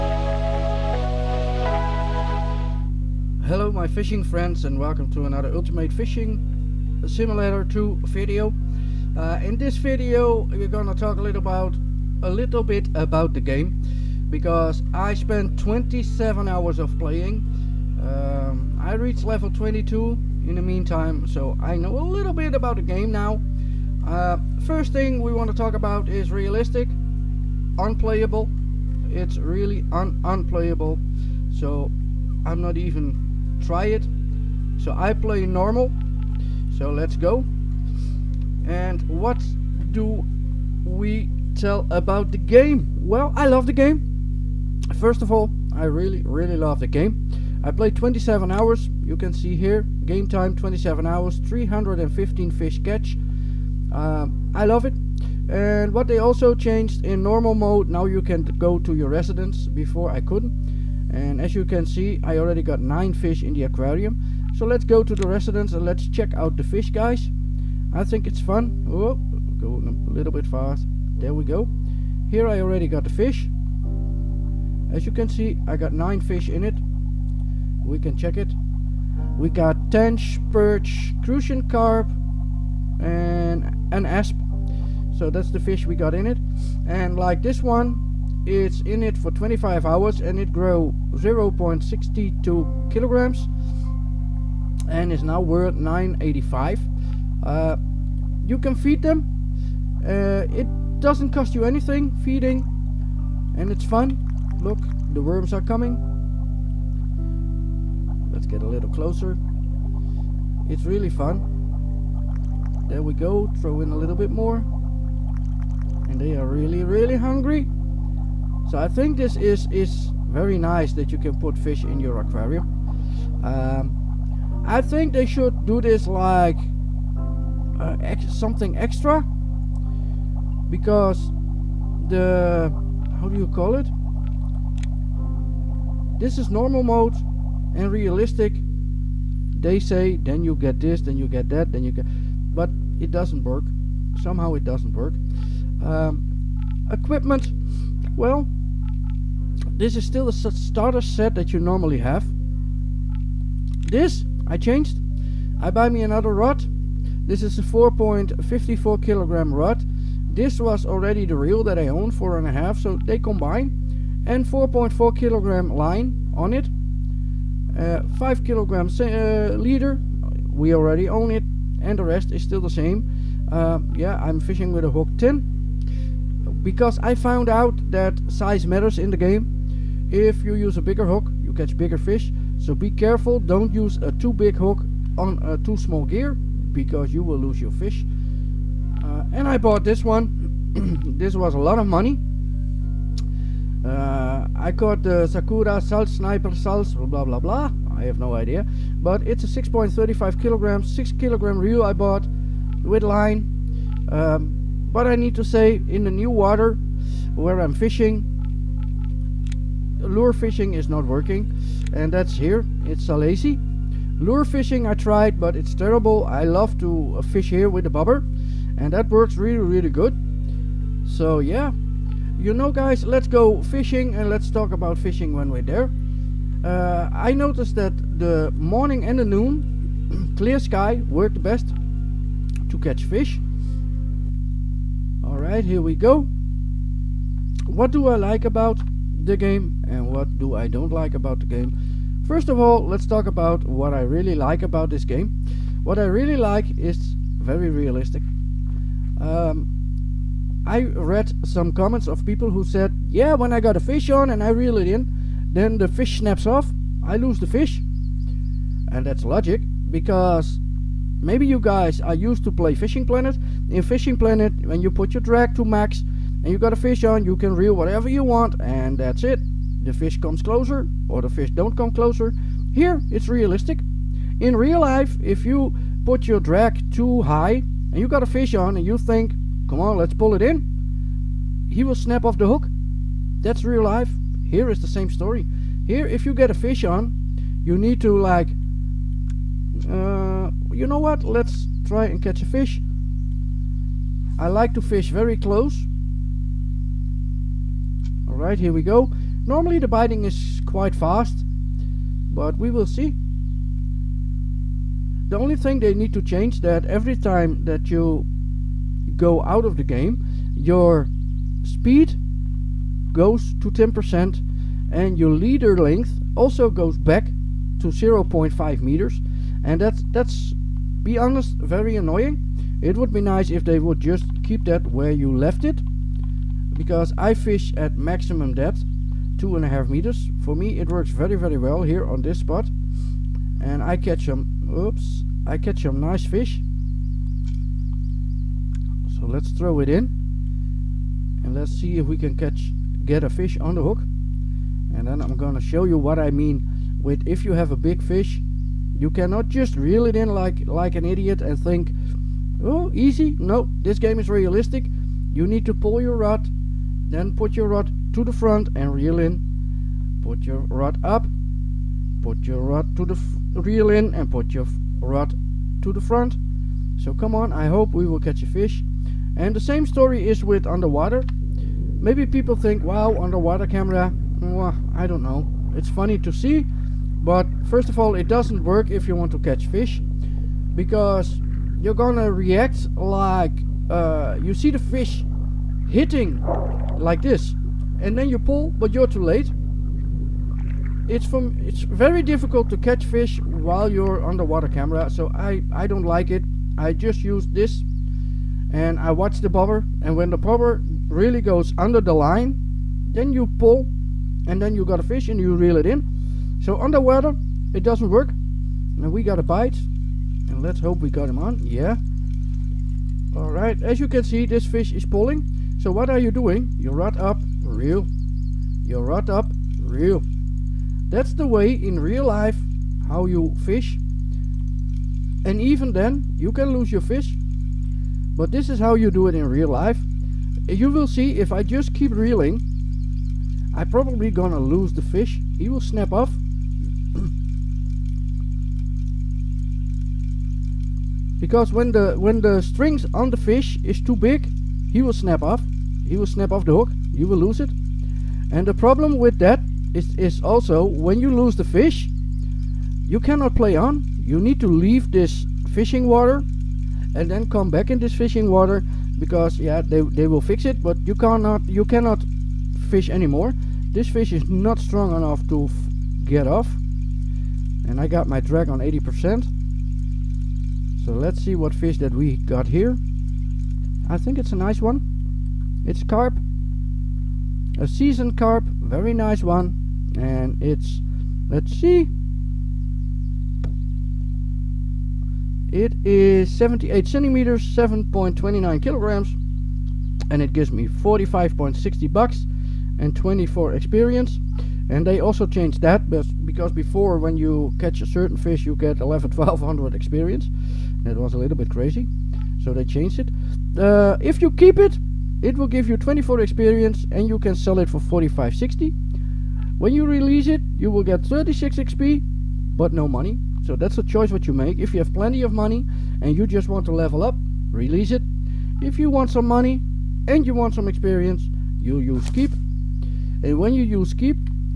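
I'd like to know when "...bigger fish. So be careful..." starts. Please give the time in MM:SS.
03:01.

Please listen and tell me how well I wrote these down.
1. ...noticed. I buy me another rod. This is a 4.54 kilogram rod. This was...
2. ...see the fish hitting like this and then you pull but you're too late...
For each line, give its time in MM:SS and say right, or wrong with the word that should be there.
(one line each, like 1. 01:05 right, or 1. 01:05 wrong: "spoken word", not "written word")
1. 02:34 wrong: "changed", not "noticed"
2. 06:24 right.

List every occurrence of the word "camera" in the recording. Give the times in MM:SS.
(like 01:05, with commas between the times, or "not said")
06:13, 06:34.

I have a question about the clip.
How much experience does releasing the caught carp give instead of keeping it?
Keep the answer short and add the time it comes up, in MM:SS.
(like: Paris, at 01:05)
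36 XP, at 08:31.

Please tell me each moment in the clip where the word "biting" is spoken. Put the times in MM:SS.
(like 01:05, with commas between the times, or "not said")
04:59.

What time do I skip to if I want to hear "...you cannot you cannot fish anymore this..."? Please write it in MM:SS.
07:41.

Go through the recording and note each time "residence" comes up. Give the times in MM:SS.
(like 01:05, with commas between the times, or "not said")
00:59, 01:05.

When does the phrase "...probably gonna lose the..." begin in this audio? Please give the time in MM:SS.
07:13.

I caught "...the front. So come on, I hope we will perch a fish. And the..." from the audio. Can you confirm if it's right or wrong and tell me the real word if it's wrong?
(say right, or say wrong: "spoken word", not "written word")
wrong: "catch", not "perch".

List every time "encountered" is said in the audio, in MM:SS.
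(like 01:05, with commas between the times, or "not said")
not said.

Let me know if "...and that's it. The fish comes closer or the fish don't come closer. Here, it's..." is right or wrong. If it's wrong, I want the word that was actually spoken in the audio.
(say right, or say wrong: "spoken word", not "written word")
right.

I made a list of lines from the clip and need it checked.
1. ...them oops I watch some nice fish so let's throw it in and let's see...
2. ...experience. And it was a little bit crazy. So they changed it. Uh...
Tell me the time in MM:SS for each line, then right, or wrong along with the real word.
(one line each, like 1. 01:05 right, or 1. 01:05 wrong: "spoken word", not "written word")
1. 05:34 wrong: "catch", not "watch"
2. 08:19 right.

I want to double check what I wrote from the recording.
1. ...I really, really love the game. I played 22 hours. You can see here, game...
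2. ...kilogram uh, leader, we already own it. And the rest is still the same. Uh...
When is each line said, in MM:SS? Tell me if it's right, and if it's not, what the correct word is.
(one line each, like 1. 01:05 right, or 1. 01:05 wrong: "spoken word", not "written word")
1. 00:45 wrong: "27", not "22"
2. 02:48 right.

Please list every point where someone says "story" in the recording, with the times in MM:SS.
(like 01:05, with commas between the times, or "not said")
04:45, 06:09.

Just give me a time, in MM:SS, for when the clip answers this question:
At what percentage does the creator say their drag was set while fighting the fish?
07:48.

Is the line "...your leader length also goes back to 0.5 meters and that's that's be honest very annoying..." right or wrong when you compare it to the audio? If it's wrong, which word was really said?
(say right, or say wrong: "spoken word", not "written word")
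right.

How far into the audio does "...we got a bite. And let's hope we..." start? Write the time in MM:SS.
06:49.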